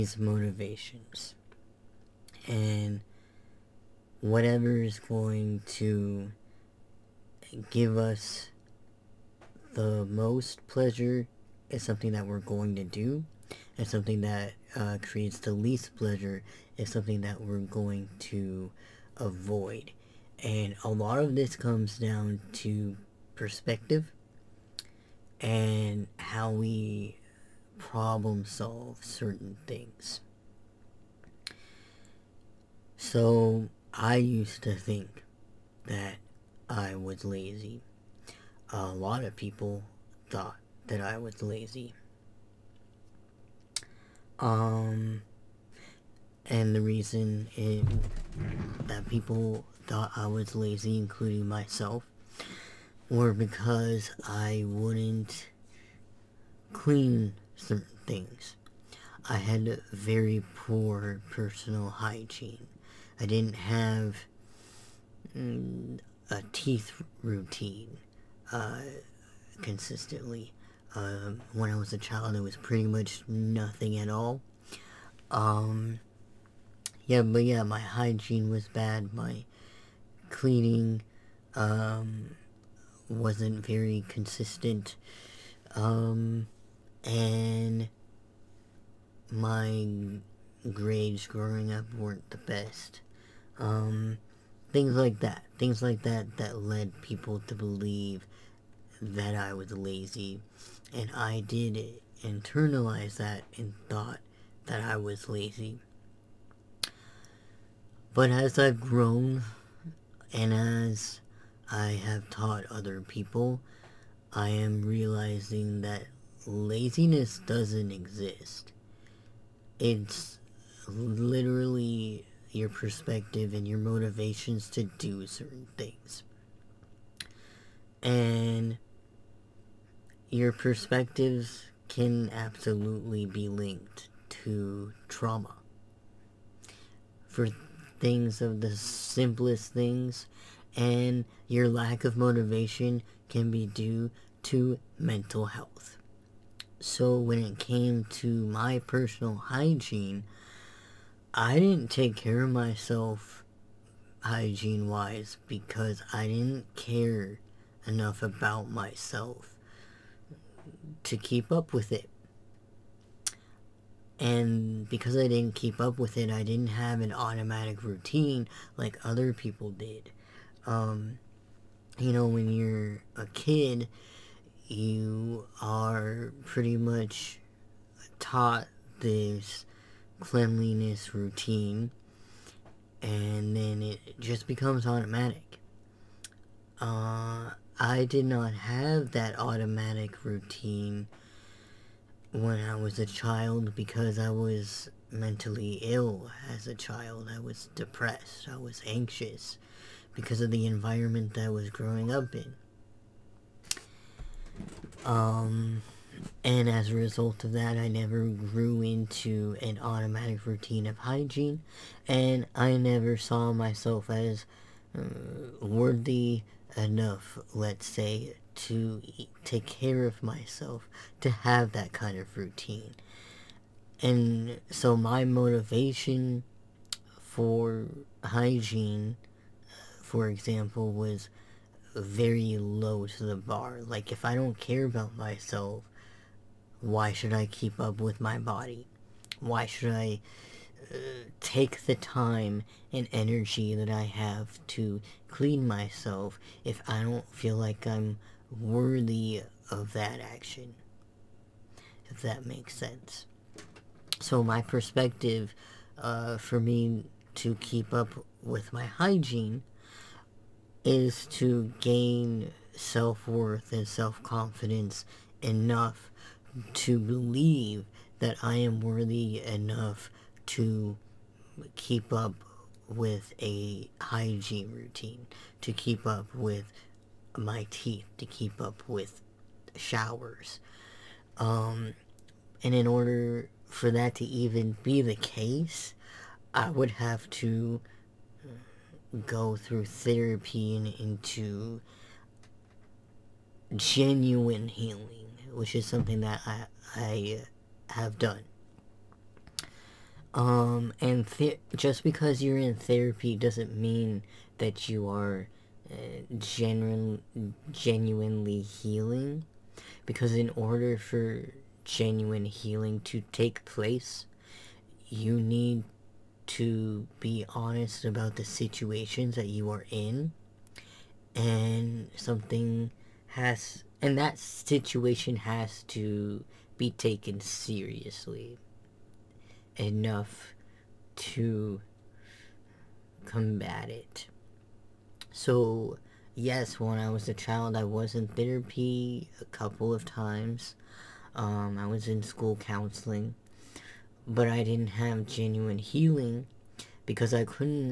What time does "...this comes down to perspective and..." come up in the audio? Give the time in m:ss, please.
0:21.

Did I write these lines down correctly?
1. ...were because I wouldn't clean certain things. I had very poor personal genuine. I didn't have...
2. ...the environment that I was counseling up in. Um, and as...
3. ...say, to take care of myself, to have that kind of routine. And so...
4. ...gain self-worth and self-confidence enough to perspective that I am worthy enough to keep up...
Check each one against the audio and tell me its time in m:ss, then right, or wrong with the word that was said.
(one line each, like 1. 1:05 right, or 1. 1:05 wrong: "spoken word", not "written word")
1. 0:53 wrong: "hygiene", not "genuine"
2. 3:20 wrong: "growing", not "counseling"
3. 3:37 right
4. 4:21 wrong: "believe", not "perspective".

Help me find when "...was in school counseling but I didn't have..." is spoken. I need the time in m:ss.
5:41.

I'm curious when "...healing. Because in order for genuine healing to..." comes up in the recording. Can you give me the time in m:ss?
5:08.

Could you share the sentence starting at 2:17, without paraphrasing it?
For things of the simplest things, and your lack of motivation can be due to mental health.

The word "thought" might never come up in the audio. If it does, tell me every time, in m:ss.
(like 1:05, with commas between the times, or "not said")
0:40, 0:49, 1:43.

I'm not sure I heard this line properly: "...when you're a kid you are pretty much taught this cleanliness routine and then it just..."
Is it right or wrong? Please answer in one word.
right.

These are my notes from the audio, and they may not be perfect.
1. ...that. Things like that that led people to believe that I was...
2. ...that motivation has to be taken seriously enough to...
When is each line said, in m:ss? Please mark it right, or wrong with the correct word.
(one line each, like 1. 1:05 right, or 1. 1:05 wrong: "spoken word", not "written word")
1. 1:35 right
2. 5:24 wrong: "situation", not "motivation".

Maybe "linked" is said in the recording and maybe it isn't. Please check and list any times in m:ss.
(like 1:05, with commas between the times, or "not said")
2:13.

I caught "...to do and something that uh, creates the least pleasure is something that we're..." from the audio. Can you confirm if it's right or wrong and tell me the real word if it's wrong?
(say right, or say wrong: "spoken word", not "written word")
right.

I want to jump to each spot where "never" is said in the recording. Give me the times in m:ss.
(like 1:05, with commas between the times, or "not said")
3:27, 3:32.